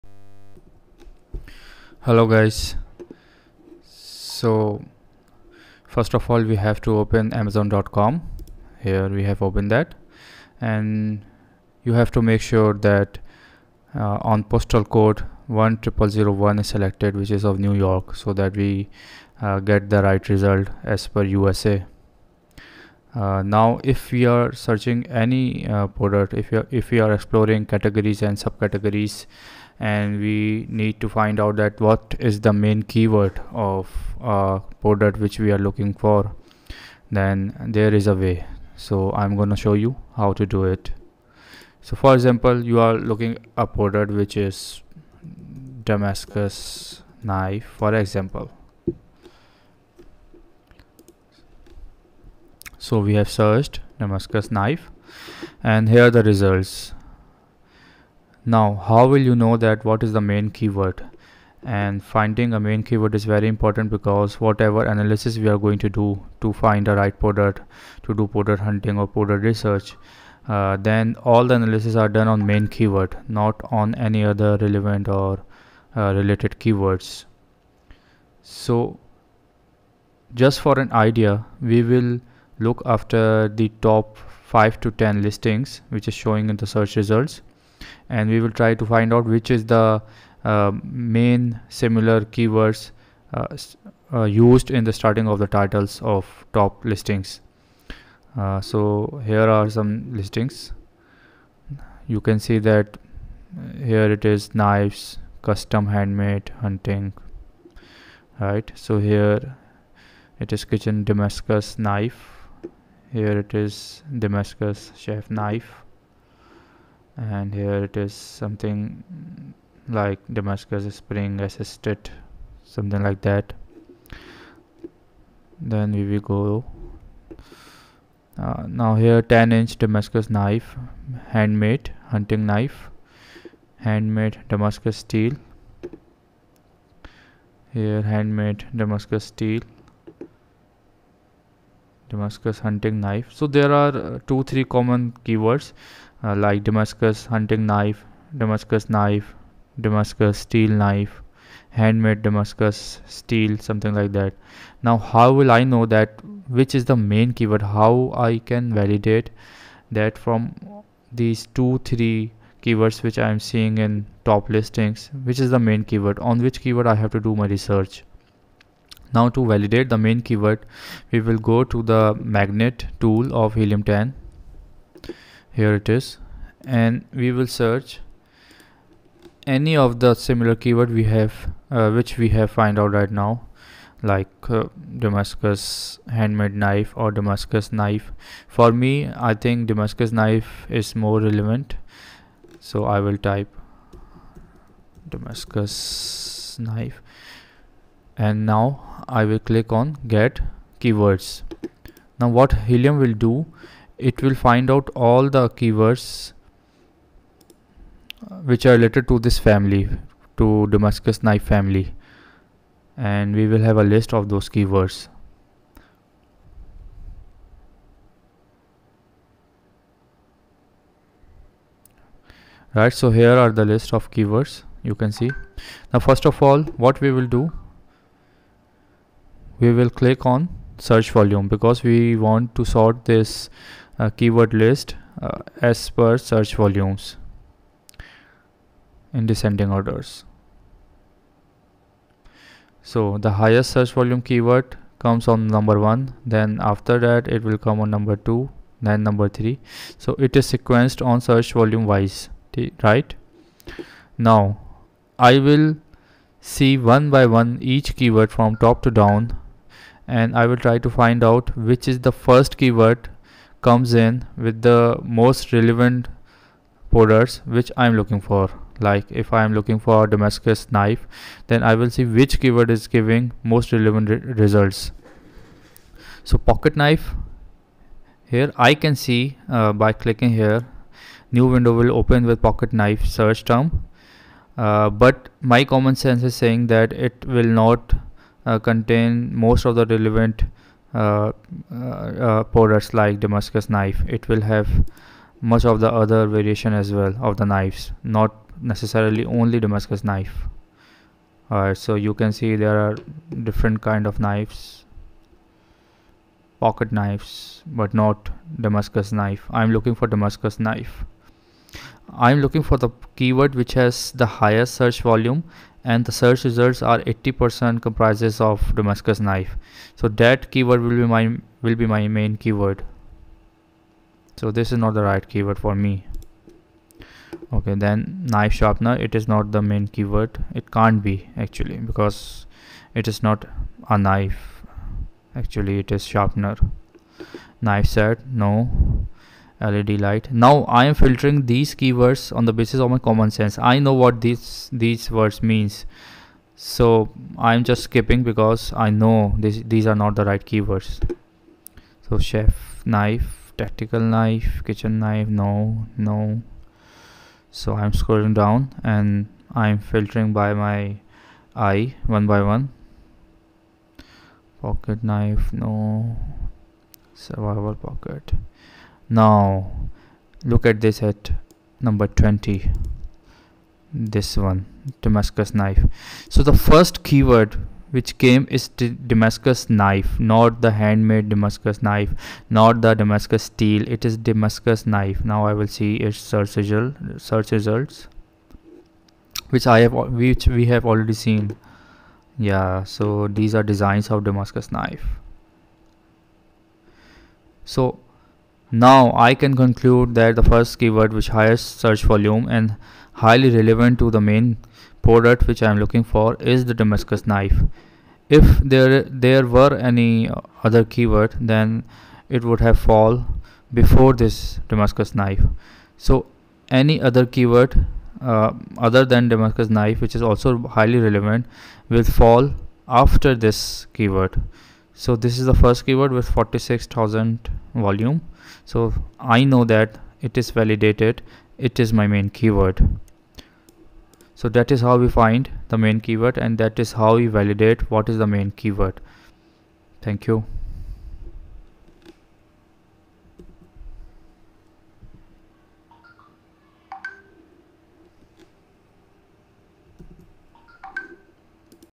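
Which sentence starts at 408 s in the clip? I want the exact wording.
If there there were any other keyword then it would have fall before this Damascus knife.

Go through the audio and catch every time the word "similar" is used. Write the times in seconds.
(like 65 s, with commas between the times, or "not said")
91 s, 180 s.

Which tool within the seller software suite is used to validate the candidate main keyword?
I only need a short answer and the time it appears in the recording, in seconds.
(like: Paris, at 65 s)
Magnet, at 172 s.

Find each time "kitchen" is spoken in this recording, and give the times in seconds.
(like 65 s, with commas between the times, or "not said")
110 s, 354 s.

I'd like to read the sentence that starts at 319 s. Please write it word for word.
So that keyword will be my will be my main keyword.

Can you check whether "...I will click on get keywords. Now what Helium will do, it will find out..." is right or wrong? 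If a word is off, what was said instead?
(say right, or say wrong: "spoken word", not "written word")
right.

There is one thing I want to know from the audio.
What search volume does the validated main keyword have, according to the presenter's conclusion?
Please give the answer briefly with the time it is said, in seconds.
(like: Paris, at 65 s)
46000, at 426 s.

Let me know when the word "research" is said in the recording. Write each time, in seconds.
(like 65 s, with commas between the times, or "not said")
69 s, 167 s.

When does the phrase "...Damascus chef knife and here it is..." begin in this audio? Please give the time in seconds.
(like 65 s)
114 s.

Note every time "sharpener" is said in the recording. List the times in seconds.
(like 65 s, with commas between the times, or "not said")
328 s, 336 s.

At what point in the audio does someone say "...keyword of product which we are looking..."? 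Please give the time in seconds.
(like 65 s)
32 s.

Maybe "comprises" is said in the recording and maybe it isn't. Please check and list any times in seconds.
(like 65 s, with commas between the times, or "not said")
317 s.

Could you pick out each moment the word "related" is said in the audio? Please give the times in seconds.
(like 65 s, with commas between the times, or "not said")
76 s, 208 s.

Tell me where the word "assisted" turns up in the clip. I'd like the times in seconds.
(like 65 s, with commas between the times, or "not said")
121 s.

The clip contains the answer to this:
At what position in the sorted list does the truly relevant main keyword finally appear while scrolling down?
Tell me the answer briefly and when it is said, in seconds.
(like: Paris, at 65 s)
20, at 371 s.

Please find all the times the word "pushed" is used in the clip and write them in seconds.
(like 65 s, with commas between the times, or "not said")
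not said.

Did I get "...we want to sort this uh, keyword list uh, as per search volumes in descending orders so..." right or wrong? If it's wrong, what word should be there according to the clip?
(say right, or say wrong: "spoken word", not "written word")
right.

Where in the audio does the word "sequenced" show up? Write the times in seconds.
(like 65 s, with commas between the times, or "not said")
250 s.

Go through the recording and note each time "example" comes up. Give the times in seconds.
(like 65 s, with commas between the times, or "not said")
42 s, 47 s.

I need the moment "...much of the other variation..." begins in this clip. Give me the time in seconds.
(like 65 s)
295 s.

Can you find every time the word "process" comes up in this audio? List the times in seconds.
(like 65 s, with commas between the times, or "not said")
not said.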